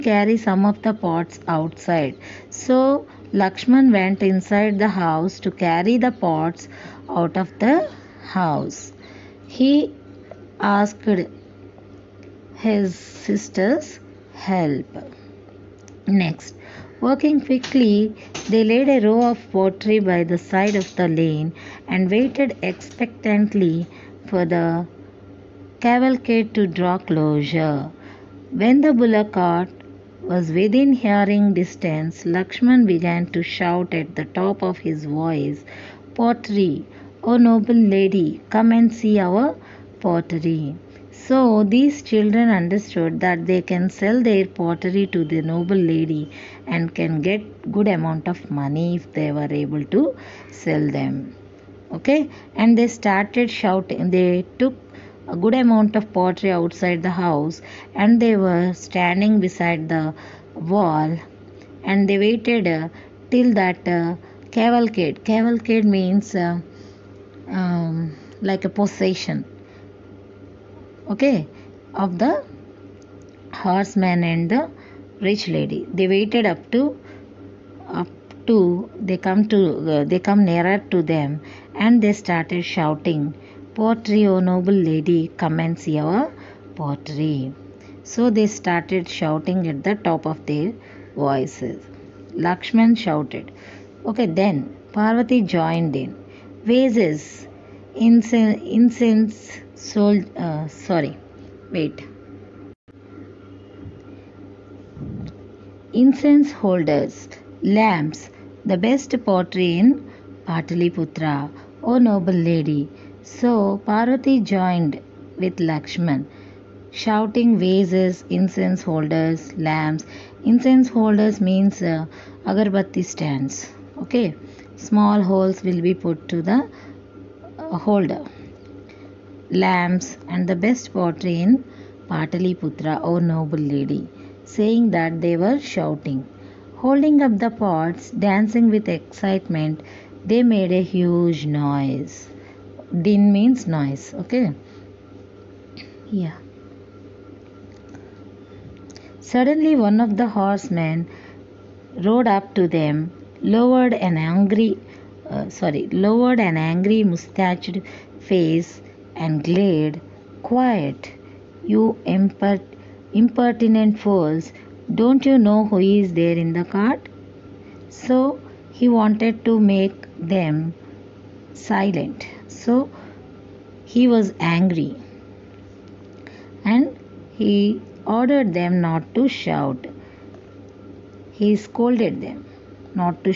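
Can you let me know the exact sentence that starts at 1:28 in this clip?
So they started shouting at the top of their voices.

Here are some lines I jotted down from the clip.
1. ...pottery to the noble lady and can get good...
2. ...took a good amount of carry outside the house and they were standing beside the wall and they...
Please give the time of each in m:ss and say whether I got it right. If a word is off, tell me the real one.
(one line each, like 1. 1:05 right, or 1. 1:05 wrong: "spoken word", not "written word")
1. 0:44 right
2. 0:54 wrong: "pottery", not "carry".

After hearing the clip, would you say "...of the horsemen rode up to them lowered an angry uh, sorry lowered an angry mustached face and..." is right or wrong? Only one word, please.
right.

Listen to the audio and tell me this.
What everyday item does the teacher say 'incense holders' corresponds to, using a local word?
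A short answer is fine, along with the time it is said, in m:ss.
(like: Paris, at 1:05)
agarbatti stands, at 2:02.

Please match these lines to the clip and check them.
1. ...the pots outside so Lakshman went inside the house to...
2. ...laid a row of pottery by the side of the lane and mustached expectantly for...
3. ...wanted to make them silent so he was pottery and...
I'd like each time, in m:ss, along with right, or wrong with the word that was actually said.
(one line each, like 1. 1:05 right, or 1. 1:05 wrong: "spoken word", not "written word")
1. 0:00 right
2. 0:18 wrong: "waited", not "mustached"
3. 2:48 wrong: "angry", not "pottery".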